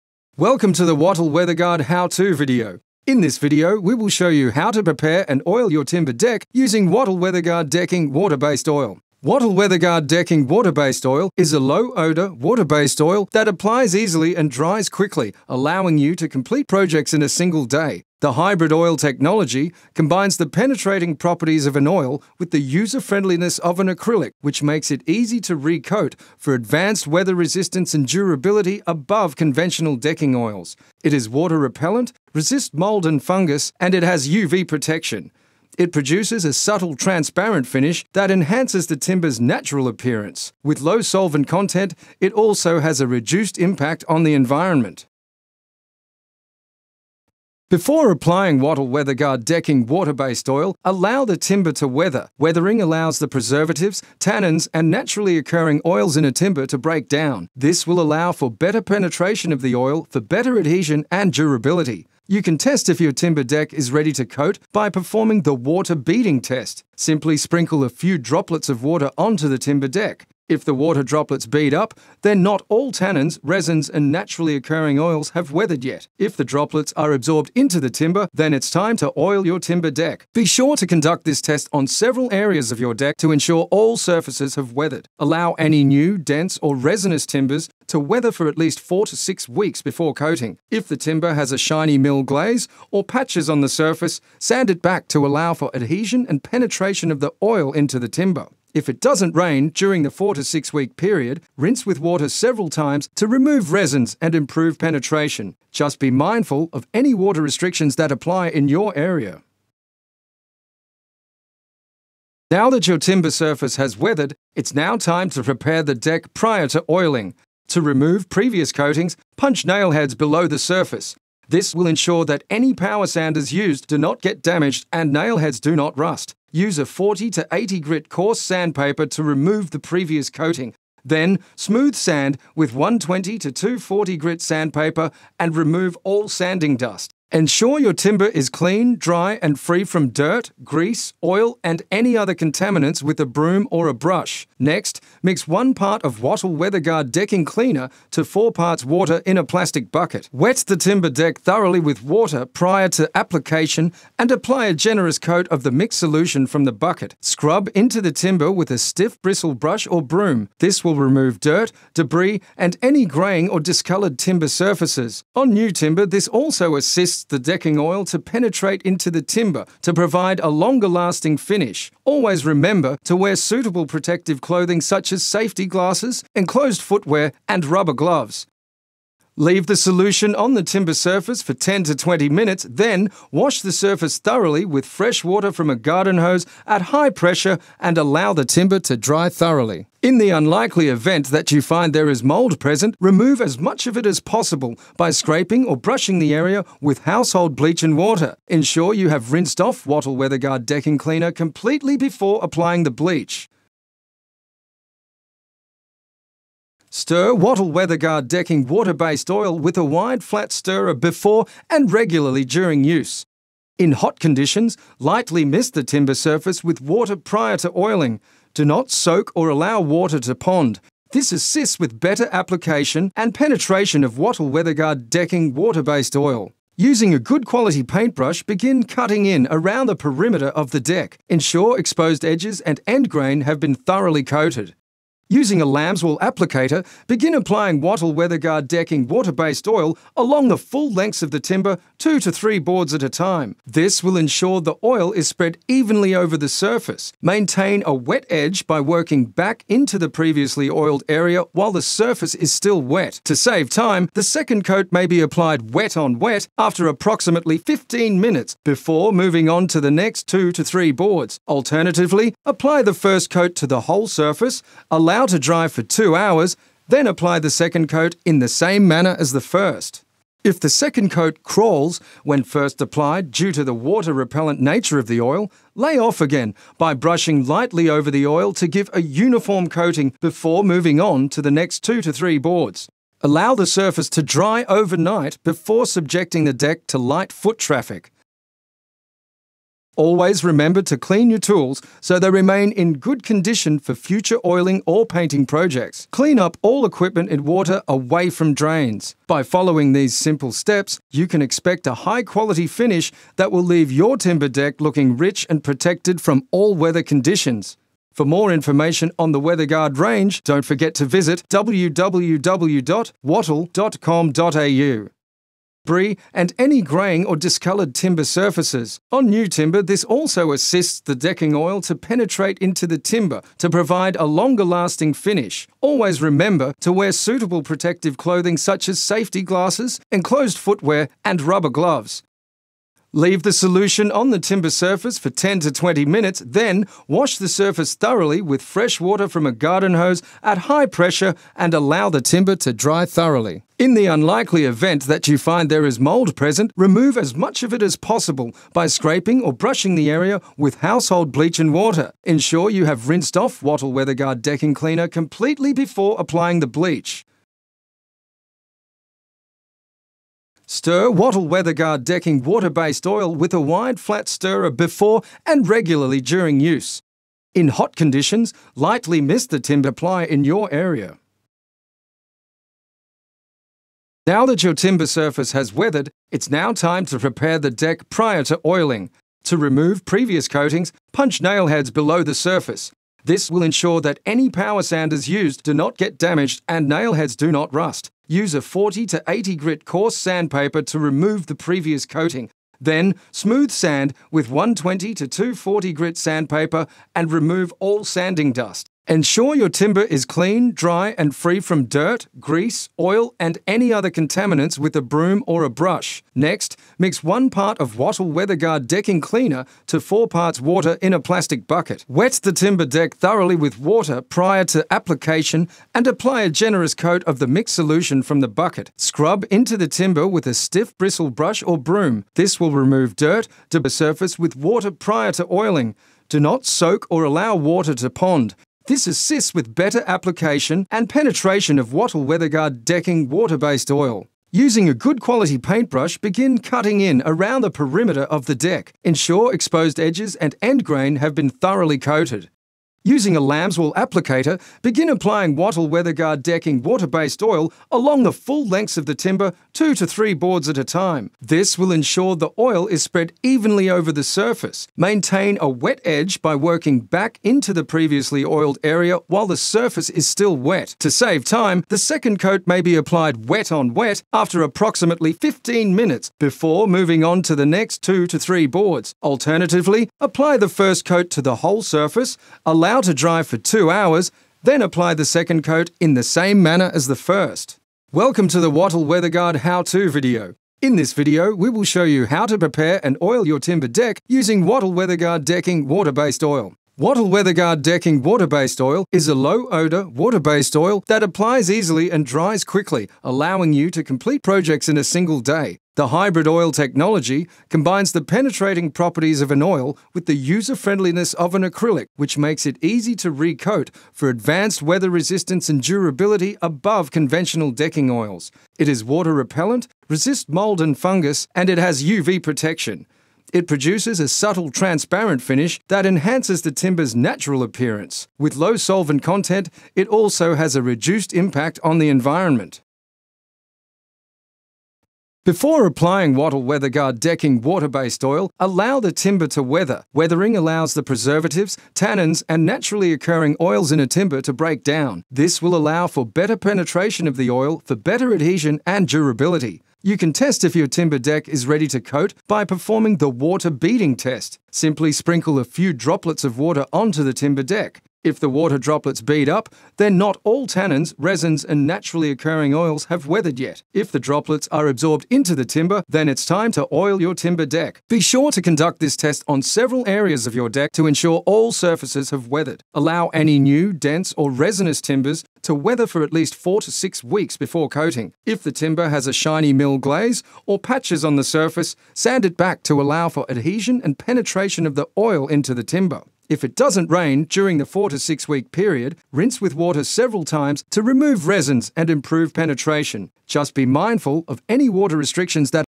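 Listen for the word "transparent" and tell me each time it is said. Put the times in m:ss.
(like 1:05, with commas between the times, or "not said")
0:36, 8:34.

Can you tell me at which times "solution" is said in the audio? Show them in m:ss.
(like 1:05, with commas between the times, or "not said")
2:35, 2:59, 5:33, 6:57.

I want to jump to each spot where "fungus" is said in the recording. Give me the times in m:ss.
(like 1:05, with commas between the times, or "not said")
0:33, 8:30.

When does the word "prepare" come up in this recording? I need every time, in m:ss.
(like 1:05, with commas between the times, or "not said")
0:04, 1:55, 6:17, 8:02.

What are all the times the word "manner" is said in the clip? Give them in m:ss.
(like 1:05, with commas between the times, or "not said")
4:28, 7:56.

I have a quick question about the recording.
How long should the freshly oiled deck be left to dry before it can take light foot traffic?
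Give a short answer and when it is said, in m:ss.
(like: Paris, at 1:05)
overnight, at 4:44.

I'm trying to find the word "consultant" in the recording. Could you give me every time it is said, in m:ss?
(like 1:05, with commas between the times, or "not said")
not said.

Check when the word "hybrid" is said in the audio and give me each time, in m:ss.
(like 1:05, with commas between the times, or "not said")
0:18, 8:16.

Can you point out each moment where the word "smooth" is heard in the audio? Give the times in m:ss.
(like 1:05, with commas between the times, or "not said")
2:11, 6:33.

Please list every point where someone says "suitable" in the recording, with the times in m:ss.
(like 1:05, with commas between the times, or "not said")
2:53, 5:27.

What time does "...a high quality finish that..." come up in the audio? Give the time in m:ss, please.
5:01.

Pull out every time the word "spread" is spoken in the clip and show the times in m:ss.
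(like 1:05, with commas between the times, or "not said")
4:05, 7:33.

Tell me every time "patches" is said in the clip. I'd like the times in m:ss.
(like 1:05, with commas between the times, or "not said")
1:33, 9:30.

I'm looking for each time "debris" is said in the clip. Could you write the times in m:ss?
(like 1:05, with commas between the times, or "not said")
2:41, 5:15.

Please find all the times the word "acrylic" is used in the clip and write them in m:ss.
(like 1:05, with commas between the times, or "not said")
0:23, 8:21.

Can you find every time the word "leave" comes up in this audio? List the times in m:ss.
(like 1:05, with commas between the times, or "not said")
2:59, 5:03, 5:33.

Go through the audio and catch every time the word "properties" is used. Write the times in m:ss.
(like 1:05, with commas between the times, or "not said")
0:21, 8:18.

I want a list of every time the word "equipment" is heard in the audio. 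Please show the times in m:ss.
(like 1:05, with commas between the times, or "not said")
4:56.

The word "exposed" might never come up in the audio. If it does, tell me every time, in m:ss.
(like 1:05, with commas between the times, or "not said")
3:51, 7:19.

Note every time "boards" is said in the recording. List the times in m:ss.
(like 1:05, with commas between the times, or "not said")
4:02, 4:20, 4:42, 7:30, 7:48.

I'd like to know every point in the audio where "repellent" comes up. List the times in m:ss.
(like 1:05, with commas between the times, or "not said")
0:31, 4:34, 8:29.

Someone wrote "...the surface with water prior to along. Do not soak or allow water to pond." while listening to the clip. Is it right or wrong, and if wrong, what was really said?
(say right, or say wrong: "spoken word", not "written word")
wrong: "oiling", not "along".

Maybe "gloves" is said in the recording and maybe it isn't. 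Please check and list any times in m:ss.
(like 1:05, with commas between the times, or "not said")
2:57, 5:31.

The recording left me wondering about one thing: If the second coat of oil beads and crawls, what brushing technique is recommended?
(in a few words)
lay off again.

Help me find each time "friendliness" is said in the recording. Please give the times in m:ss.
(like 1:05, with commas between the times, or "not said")
0:22, 8:20.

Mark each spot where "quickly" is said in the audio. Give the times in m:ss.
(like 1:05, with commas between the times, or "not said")
0:14, 8:12.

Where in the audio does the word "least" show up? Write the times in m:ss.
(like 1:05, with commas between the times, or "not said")
1:28, 9:26.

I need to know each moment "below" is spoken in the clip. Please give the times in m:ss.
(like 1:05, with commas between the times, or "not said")
2:00, 6:21.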